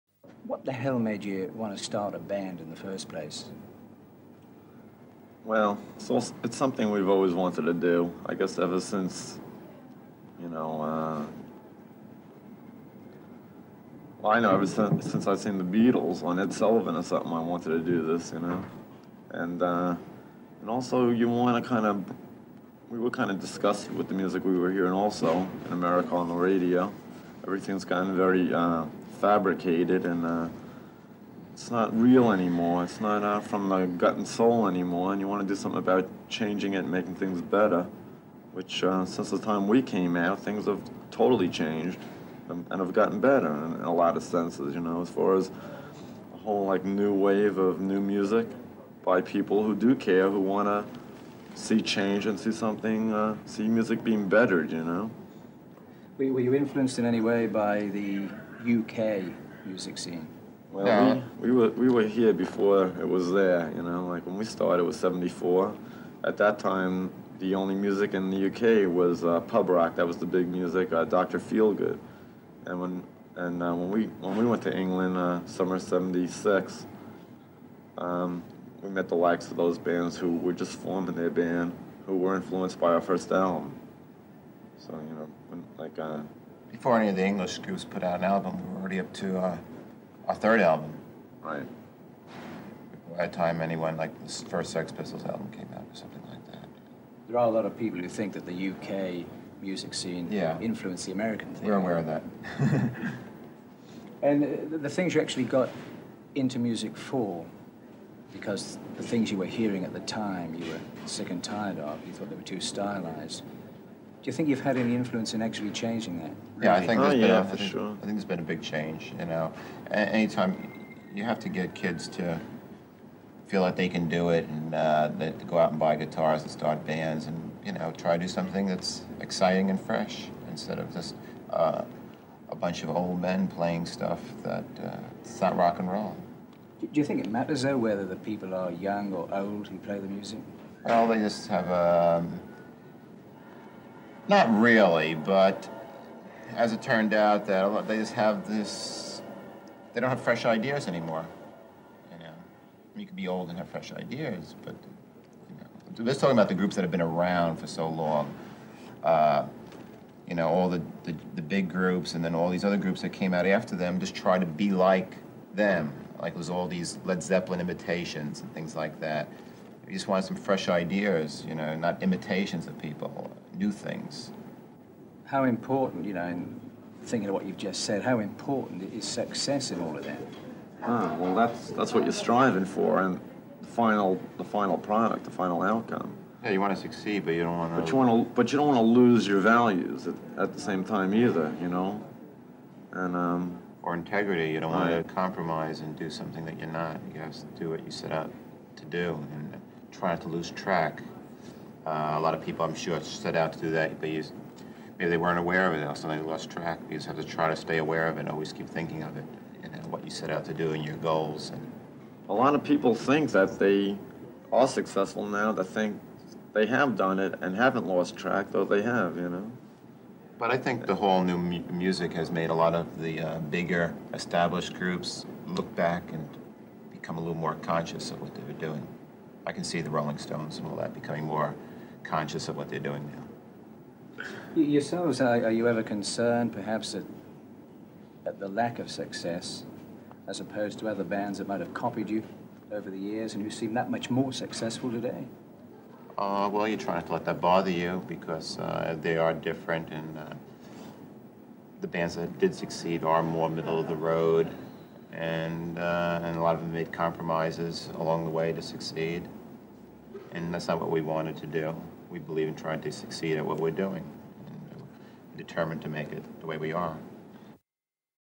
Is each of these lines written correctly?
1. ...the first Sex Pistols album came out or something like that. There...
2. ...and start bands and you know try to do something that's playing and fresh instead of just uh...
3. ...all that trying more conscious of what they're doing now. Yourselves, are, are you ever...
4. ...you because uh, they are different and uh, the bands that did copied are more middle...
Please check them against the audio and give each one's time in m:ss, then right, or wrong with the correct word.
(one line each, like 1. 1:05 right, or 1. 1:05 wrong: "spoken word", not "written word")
1. 1:34 right
2. 2:06 wrong: "exciting", not "playing"
3. 3:50 wrong: "becoming", not "trying"
4. 4:07 wrong: "succeed", not "copied".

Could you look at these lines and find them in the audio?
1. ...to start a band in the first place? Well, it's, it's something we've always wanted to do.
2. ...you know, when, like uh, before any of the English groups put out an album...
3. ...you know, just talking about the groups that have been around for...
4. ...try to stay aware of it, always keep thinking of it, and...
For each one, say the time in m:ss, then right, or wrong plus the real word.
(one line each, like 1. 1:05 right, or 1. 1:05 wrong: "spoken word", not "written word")
1. 0:01 right
2. 1:25 right
3. 2:35 right
4. 3:27 right.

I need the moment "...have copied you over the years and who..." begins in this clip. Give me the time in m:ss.
4:01.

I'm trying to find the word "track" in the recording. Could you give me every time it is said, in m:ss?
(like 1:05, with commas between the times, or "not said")
3:20, 3:26, 3:38.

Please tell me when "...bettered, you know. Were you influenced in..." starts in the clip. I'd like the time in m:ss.
0:54.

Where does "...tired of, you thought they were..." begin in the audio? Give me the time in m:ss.
1:51.